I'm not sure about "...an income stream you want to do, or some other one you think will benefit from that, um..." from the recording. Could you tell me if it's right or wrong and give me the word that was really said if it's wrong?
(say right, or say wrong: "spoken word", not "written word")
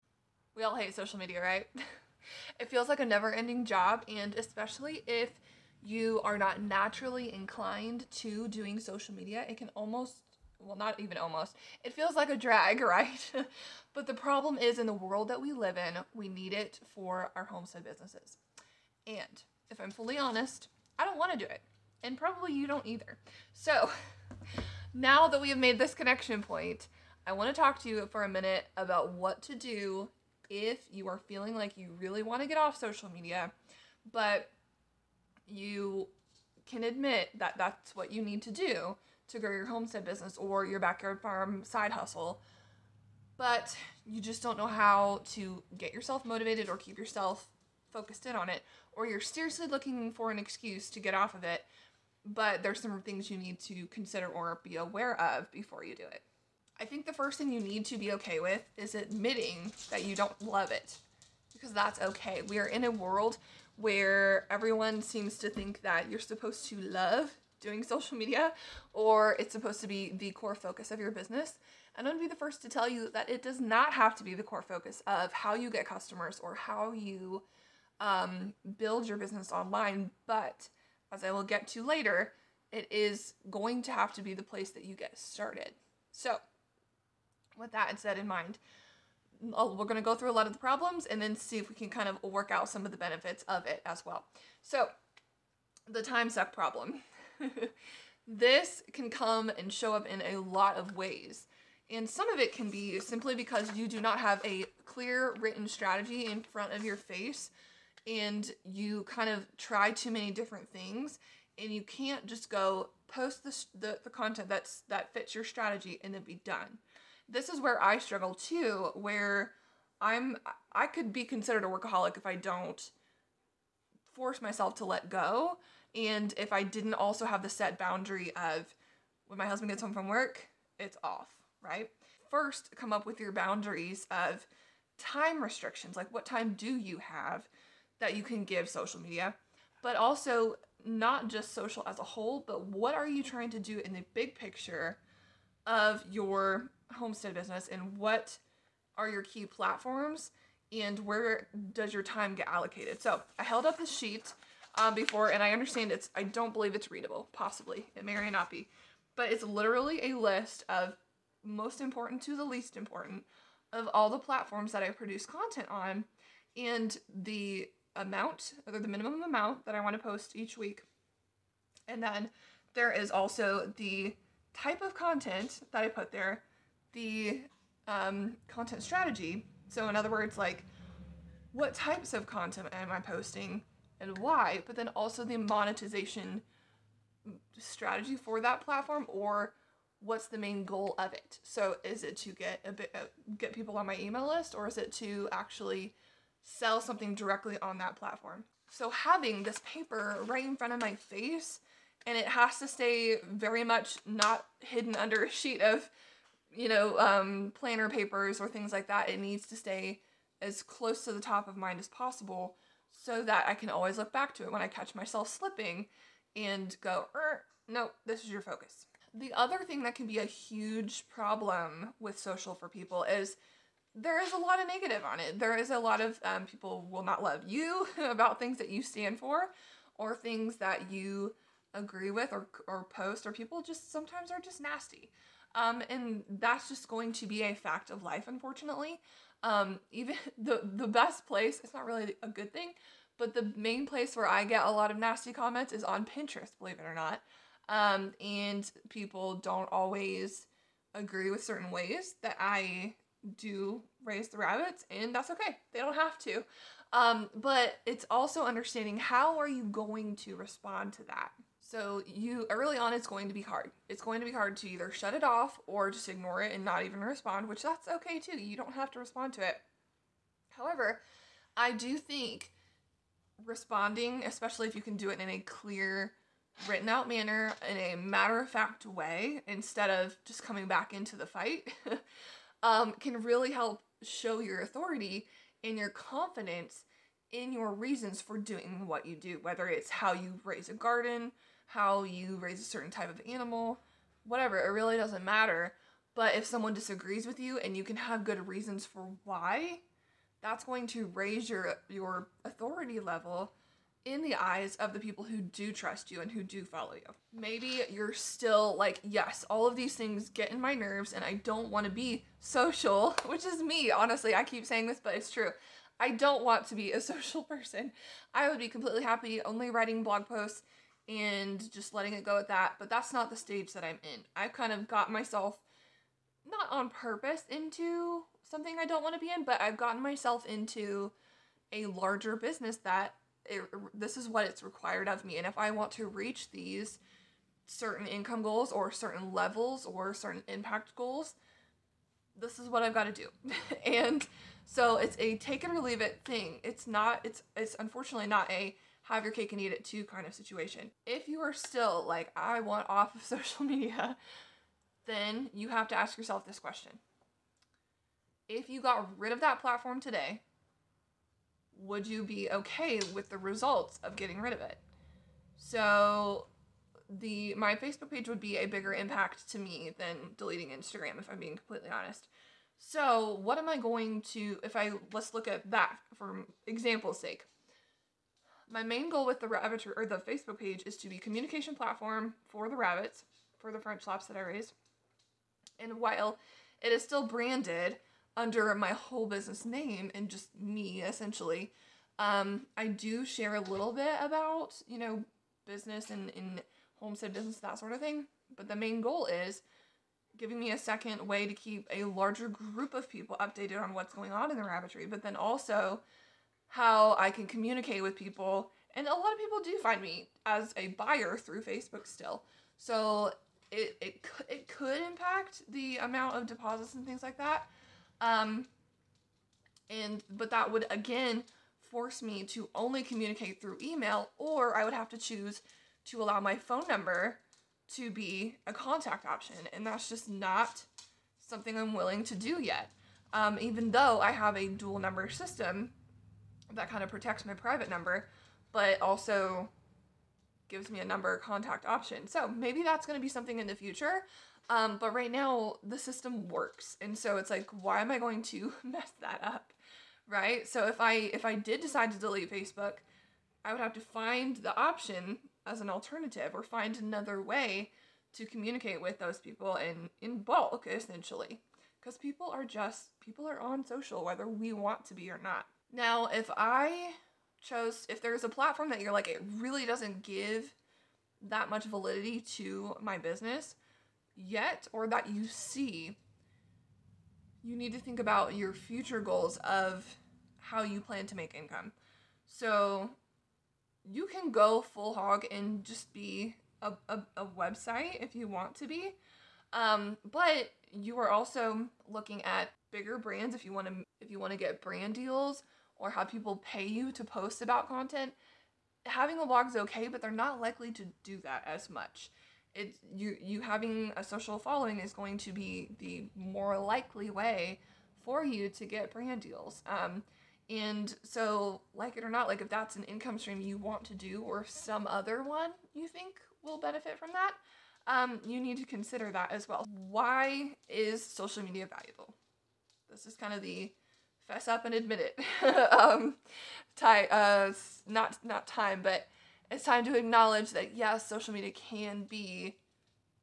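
right.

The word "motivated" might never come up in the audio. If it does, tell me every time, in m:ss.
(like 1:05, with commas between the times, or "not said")
0:46.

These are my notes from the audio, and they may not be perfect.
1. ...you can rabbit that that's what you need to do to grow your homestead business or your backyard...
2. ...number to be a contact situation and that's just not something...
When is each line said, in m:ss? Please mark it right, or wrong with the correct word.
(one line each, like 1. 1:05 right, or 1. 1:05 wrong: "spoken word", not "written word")
1. 0:35 wrong: "admit", not "rabbit"
2. 7:06 wrong: "option", not "situation".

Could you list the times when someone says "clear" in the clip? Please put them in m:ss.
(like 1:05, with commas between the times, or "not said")
1:44, 4:35.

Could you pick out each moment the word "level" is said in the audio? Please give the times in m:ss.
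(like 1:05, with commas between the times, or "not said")
5:02, 5:39.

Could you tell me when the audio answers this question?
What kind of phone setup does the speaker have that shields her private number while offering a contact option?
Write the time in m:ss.
7:14.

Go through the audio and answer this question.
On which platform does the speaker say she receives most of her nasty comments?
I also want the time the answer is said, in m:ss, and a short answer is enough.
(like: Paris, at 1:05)
Pinterest, at 4:06.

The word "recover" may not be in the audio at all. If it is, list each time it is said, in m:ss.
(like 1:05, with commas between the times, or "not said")
not said.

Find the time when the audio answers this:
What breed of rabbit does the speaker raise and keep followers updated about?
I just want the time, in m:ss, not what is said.
6:23.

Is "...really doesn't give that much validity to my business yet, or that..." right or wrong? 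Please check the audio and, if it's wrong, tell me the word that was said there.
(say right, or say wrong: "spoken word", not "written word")
right.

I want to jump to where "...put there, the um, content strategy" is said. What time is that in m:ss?
2:55.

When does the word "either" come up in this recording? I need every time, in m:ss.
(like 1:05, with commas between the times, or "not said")
0:22, 4:24.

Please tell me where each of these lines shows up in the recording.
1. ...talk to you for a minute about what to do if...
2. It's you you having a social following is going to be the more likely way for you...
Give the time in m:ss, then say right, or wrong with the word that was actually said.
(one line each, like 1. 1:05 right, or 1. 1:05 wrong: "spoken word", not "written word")
1. 0:27 right
2. 8:22 right.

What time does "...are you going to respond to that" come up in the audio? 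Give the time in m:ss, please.
4:19.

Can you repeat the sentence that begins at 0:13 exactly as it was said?
but the problem is in the world that we live in, we need it for our homestead businesses.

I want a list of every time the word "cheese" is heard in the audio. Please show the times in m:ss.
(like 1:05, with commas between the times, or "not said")
not said.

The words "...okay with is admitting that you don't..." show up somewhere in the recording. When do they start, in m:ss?
0:58.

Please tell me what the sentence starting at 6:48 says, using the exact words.
And a lot of people do find me as a buyer through Facebook still.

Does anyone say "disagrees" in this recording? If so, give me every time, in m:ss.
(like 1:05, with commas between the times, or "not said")
4:56.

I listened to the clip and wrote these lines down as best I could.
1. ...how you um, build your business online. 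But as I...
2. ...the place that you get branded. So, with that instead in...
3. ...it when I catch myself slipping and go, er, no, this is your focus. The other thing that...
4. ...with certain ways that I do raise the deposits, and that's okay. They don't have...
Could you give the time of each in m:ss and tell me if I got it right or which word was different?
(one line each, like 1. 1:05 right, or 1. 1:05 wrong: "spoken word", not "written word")
1. 1:16 right
2. 1:24 wrong: "started", not "branded"
3. 3:34 right
4. 4:11 wrong: "rabbits", not "deposits".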